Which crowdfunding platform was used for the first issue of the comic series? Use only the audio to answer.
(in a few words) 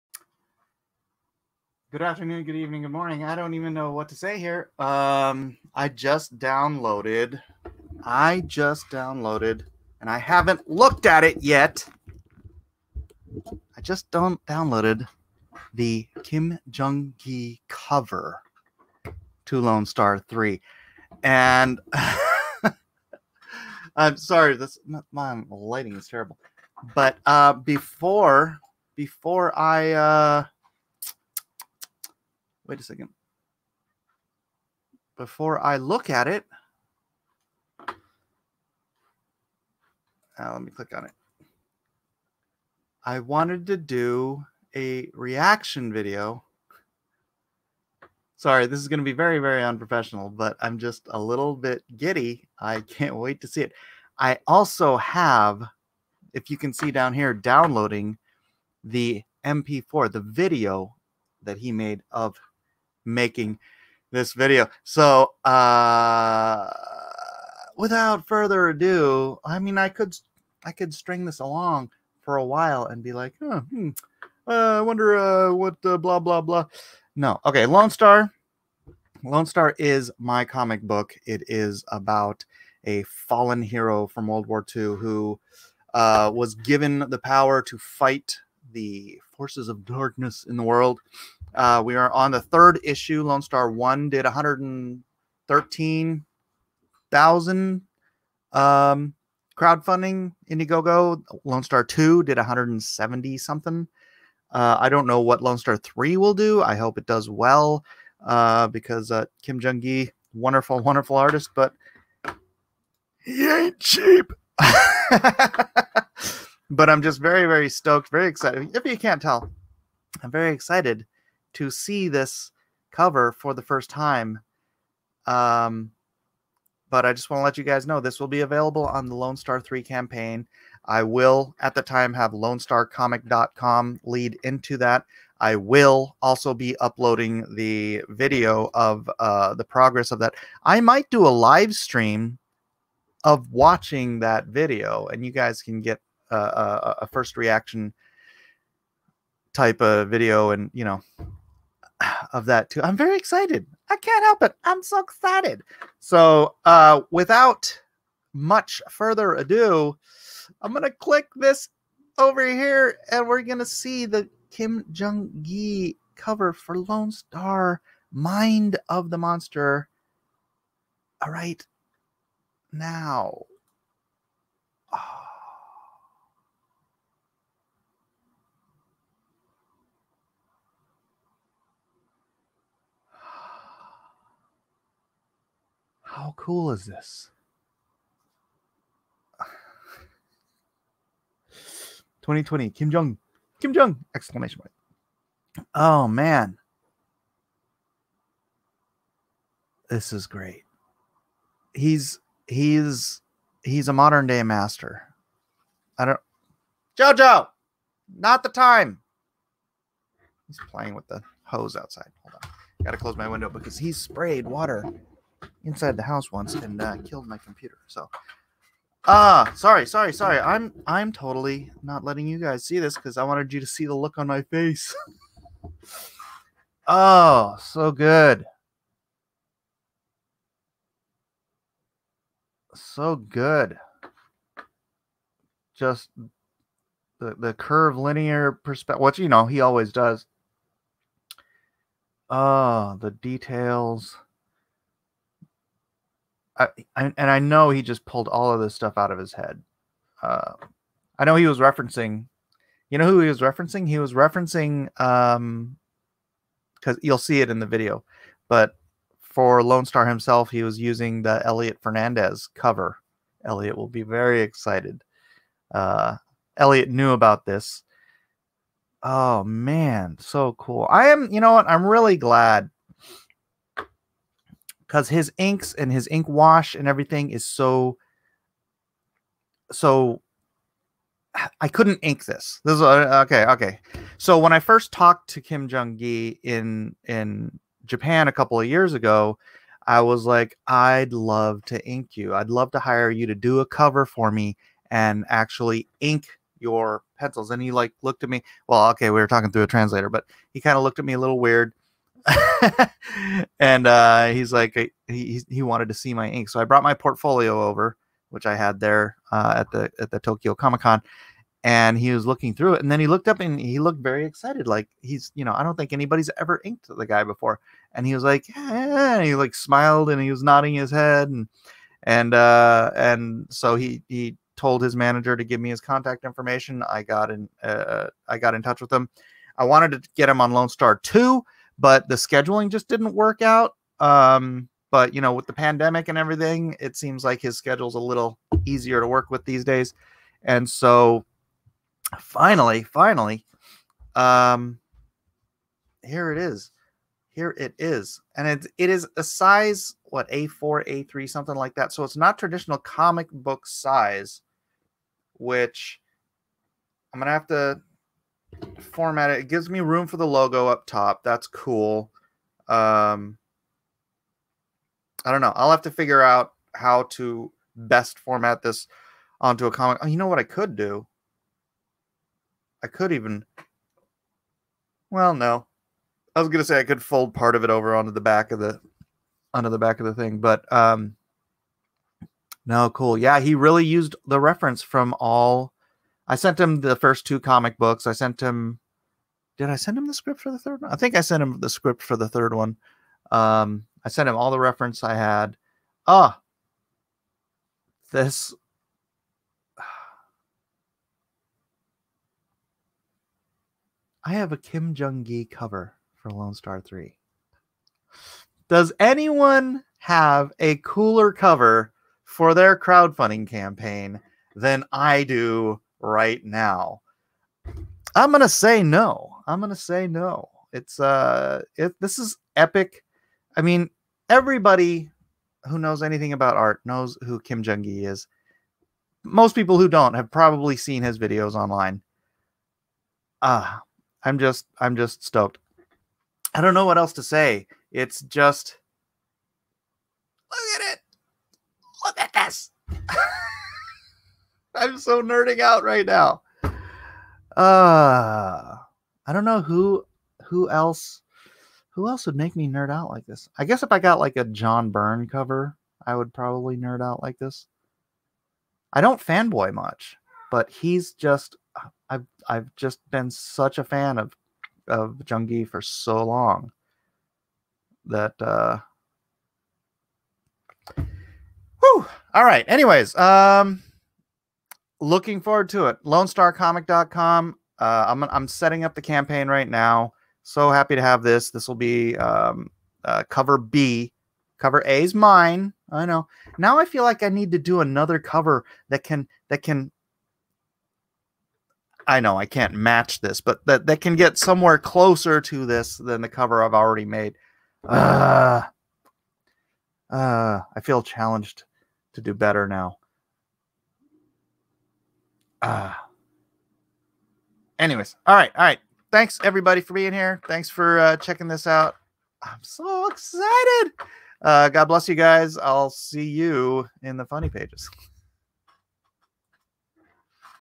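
Indiegogo.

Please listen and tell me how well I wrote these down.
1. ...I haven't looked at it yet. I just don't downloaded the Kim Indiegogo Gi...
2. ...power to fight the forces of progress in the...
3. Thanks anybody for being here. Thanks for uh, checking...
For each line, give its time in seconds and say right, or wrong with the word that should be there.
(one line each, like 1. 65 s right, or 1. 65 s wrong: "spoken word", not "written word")
1. 10 s wrong: "Jung", not "Indiegogo"
2. 87 s wrong: "darkness", not "progress"
3. 509 s wrong: "everybody", not "anybody".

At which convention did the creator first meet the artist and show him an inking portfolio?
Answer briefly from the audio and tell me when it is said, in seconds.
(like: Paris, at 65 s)
Tokyo Comic Con, at 310 s.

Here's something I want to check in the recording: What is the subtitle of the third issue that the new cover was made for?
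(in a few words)
Mind of the Monster.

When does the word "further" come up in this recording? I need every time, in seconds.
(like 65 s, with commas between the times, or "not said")
68 s, 158 s.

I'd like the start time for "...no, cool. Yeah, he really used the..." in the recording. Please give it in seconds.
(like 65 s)
382 s.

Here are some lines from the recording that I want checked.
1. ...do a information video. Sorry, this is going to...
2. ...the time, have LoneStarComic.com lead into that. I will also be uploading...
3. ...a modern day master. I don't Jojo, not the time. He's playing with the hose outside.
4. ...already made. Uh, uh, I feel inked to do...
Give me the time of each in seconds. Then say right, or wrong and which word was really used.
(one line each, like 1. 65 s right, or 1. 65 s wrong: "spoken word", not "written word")
1. 43 s wrong: "reaction", not "information"
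2. 131 s right
3. 203 s right
4. 496 s wrong: "challenged", not "inked".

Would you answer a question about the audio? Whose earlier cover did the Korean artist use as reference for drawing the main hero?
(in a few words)
Elliot Fernandez.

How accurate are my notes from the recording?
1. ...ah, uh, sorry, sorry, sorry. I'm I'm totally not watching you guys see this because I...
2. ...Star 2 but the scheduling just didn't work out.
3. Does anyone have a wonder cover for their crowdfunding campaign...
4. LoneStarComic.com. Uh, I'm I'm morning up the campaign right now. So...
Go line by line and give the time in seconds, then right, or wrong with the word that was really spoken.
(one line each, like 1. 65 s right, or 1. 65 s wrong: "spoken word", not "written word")
1. 219 s wrong: "letting", not "watching"
2. 330 s right
3. 408 s wrong: "cooler", not "wonder"
4. 476 s wrong: "setting", not "morning".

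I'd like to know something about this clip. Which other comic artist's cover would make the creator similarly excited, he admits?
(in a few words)
John Byrne.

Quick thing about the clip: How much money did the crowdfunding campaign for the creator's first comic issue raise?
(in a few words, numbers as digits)
113,000.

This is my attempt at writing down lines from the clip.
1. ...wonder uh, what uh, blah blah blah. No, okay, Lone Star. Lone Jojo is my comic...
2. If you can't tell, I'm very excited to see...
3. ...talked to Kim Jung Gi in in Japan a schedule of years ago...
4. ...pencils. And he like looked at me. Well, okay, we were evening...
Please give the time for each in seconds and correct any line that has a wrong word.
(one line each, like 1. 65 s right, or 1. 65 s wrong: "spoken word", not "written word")
1. 74 s wrong: "Star", not "Jojo"
2. 118 s right
3. 284 s wrong: "couple", not "schedule"
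4. 297 s wrong: "talking", not "evening".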